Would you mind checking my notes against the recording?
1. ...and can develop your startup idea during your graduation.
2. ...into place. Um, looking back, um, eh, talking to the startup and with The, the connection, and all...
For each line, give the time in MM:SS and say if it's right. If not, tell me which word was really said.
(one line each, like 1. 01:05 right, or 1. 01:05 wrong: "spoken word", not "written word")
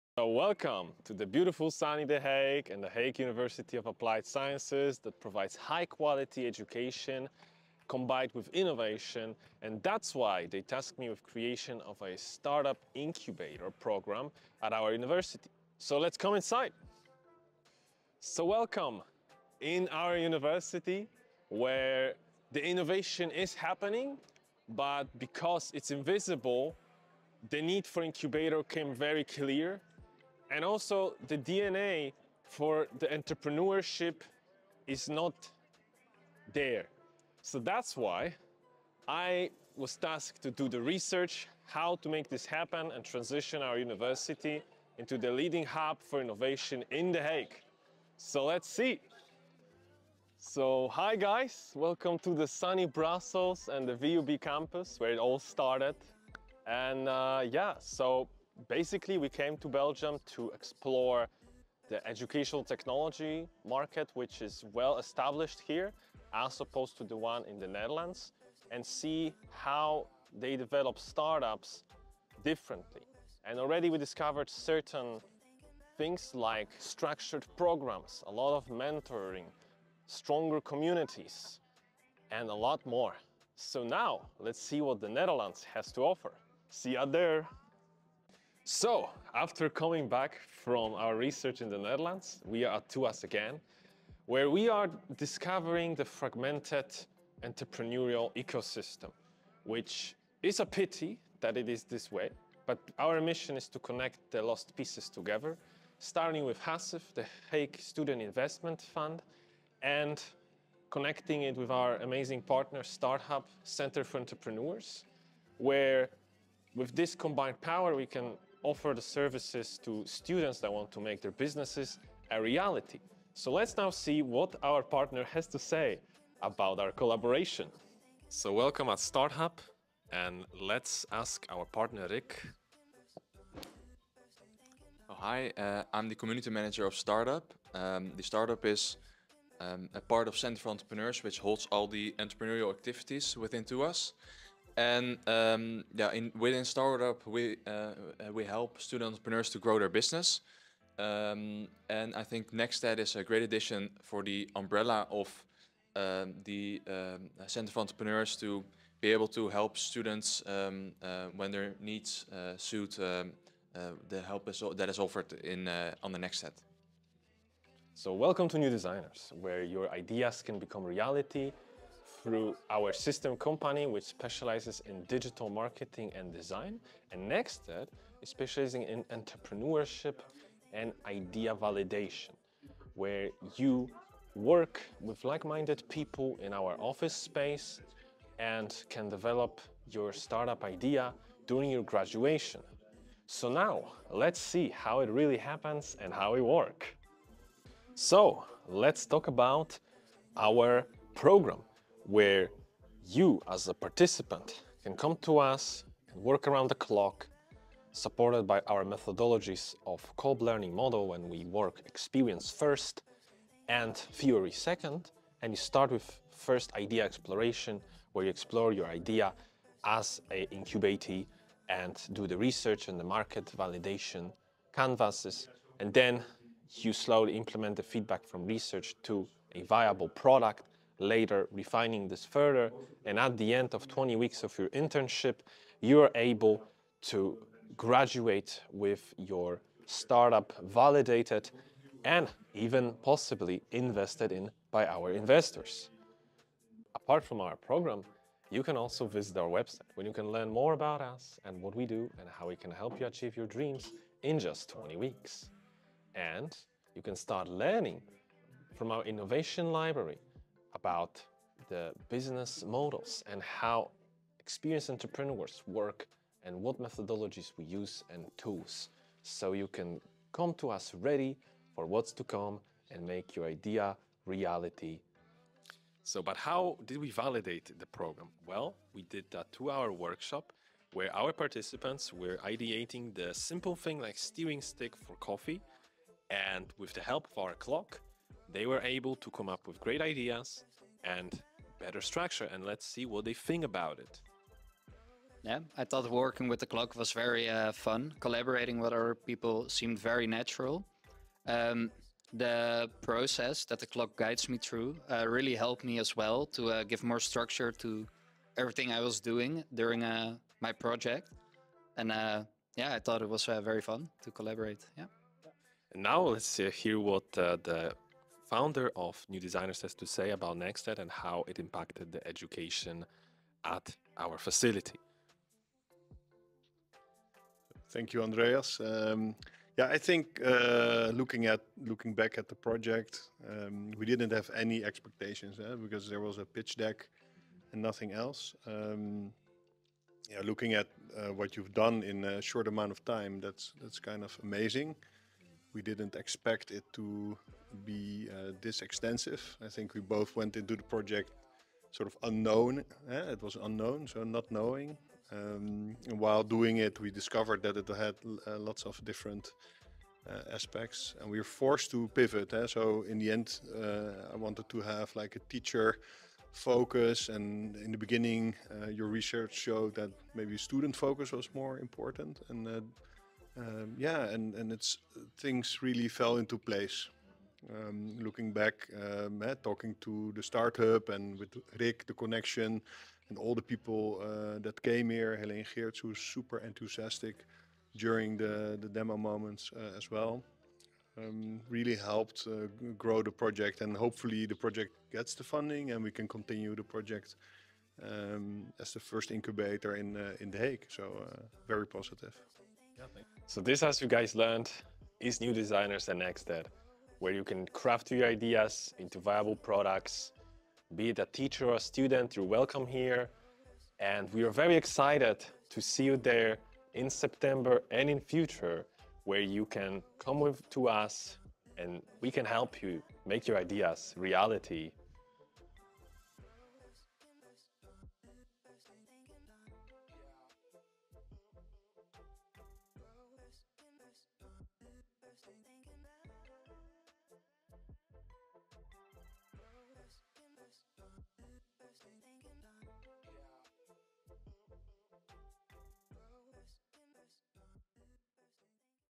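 1. 03:08 right
2. 06:16 wrong: "Rick", not "The".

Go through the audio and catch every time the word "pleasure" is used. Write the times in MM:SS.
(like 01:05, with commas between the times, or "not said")
not said.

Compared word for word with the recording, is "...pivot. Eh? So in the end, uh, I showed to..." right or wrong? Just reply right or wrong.
wrong.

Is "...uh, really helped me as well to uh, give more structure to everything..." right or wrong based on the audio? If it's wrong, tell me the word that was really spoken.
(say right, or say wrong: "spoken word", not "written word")
right.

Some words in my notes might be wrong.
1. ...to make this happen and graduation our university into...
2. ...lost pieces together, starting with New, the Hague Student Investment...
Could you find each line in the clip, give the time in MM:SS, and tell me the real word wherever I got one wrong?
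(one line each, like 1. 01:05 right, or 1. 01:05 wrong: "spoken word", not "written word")
1. 00:42 wrong: "transition", not "graduation"
2. 01:44 wrong: "HASIF", not "New".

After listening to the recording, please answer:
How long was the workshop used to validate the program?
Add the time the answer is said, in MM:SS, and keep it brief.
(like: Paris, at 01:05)
2 hours, at 04:39.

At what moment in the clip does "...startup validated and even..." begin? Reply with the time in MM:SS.
03:59.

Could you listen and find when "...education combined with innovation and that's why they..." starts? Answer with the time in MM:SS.
00:06.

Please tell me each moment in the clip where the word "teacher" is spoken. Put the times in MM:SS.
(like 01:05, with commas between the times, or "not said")
06:05, 06:51.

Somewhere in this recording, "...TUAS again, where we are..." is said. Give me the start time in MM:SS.
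01:32.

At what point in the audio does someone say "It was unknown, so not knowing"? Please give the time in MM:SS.
05:53.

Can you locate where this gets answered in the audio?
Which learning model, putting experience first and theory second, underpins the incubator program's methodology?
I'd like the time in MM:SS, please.
03:30.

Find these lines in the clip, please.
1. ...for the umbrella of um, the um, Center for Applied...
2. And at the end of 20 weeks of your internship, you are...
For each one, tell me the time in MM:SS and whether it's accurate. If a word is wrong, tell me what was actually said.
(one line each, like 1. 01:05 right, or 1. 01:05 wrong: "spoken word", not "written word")
1. 02:34 wrong: "Entrepreneurs", not "Applied"
2. 03:53 right.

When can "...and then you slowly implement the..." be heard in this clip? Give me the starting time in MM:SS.
03:45.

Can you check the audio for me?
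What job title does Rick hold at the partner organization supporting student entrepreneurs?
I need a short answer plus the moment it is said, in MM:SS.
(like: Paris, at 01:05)
Community manager, at 02:16.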